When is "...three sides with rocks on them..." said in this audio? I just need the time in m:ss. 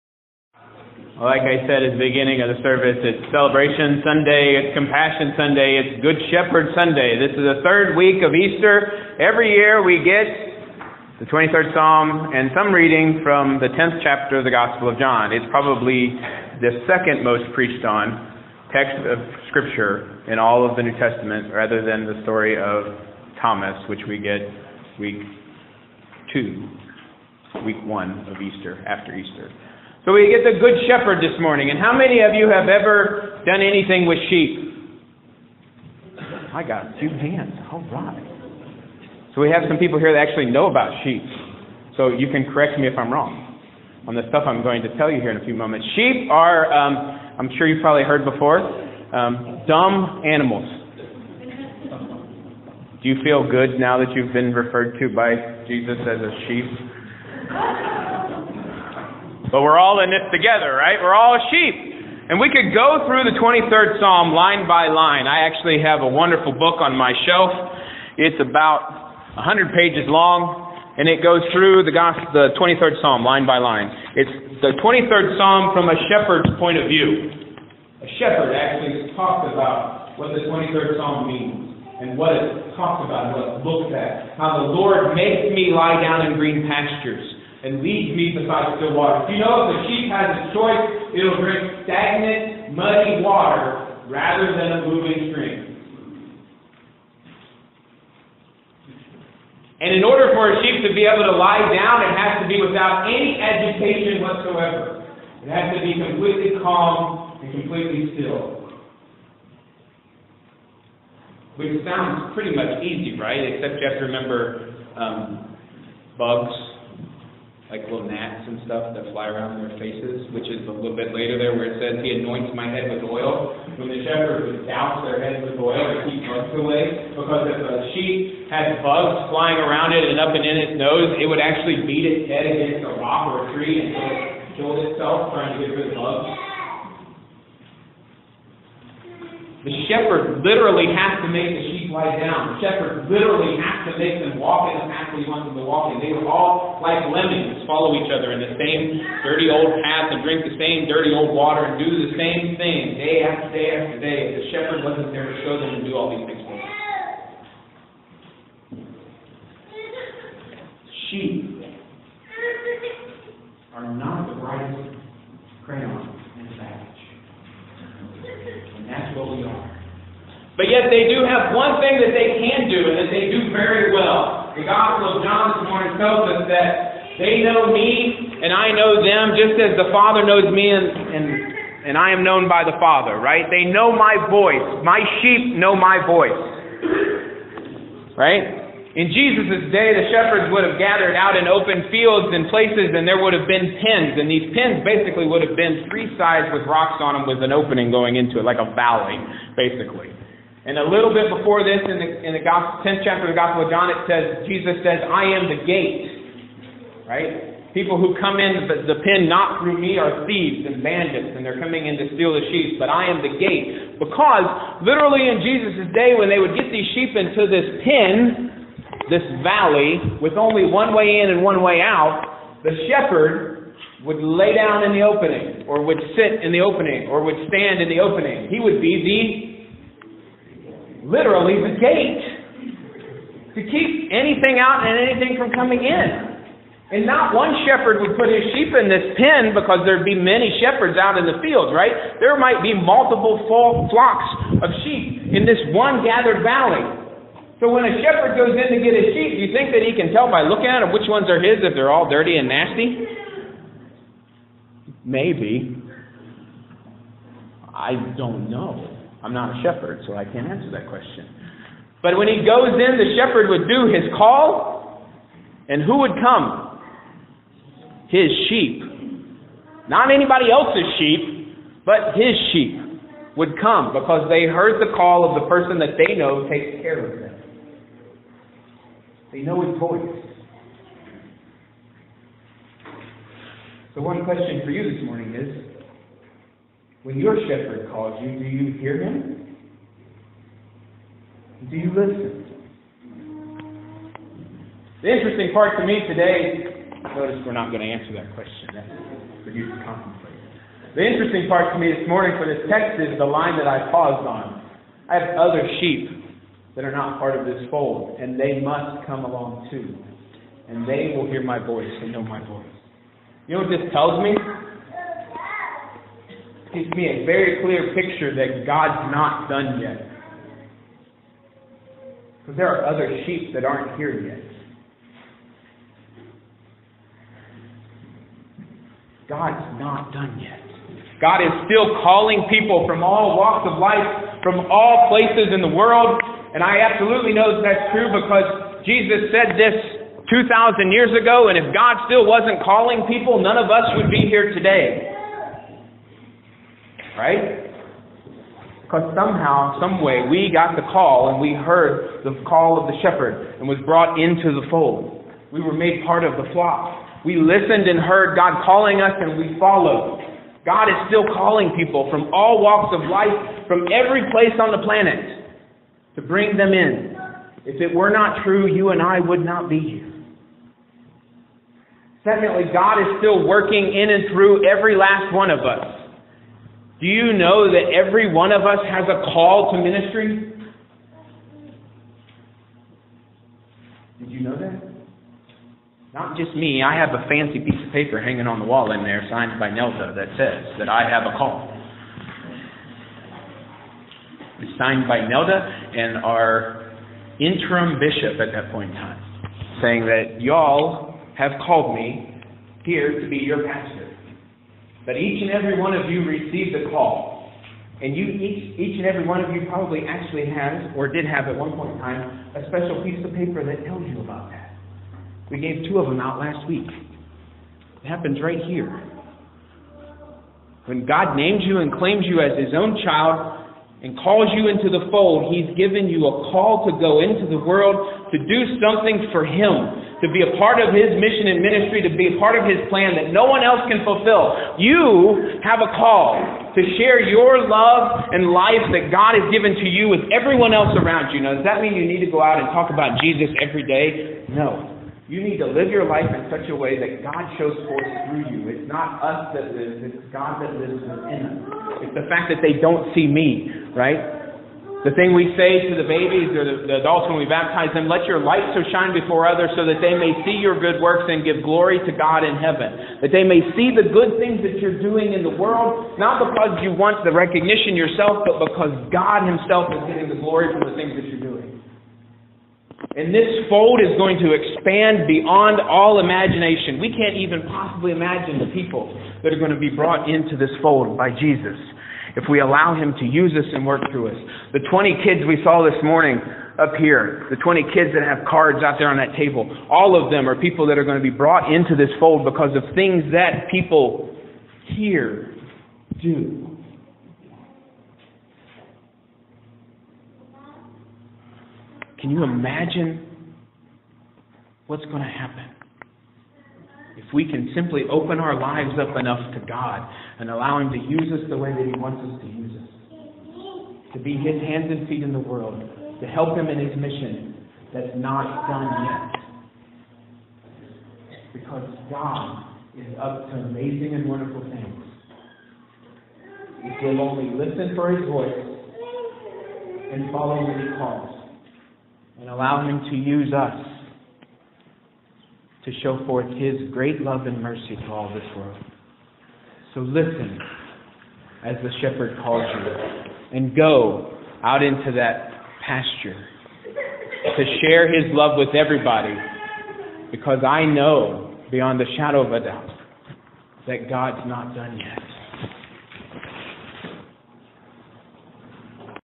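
3:15.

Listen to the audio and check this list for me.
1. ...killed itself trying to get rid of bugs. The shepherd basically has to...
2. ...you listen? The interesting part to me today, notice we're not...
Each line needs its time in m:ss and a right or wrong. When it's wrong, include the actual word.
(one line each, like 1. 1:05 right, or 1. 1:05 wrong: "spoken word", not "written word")
1. 2:14 wrong: "literally", not "basically"
2. 4:51 right.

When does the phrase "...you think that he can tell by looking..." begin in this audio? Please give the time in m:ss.
4:09.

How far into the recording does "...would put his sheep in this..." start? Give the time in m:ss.
3:58.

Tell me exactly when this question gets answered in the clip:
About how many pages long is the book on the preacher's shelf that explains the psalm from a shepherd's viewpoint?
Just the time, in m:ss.
1:09.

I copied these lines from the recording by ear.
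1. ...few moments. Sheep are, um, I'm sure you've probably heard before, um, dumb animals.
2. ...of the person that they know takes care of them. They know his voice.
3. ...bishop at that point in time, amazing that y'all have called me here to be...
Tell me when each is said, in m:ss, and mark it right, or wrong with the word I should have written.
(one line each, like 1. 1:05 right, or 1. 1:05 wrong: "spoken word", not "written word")
1. 0:45 right
2. 4:35 right
3. 6:37 wrong: "saying", not "amazing".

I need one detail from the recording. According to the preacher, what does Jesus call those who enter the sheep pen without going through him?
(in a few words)
thieves and bandits.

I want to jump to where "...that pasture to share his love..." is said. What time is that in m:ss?
9:05.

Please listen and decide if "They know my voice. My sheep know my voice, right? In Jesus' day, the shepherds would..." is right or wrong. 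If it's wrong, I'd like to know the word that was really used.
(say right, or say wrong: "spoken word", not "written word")
right.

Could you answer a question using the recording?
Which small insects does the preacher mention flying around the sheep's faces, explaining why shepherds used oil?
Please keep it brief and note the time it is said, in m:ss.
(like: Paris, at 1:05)
gnats, at 1:58.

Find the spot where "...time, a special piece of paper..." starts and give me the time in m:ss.
6:51.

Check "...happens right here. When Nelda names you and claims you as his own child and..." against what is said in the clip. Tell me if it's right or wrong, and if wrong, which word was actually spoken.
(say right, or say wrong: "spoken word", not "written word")
wrong: "God", not "Nelda".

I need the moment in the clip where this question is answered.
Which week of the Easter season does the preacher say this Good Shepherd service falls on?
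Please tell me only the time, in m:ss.
0:07.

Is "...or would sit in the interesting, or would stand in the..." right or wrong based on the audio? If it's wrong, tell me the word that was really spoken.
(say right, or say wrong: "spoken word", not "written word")
wrong: "opening", not "interesting".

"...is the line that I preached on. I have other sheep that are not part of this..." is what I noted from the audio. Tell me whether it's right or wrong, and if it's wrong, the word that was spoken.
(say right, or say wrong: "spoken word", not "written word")
wrong: "paused", not "preached".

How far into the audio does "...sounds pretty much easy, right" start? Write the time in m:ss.
1:51.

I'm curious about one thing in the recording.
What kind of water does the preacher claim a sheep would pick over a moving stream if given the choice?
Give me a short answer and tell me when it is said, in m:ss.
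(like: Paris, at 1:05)
stagnant, muddy water, at 1:31.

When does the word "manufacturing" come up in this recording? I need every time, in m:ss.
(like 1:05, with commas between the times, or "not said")
not said.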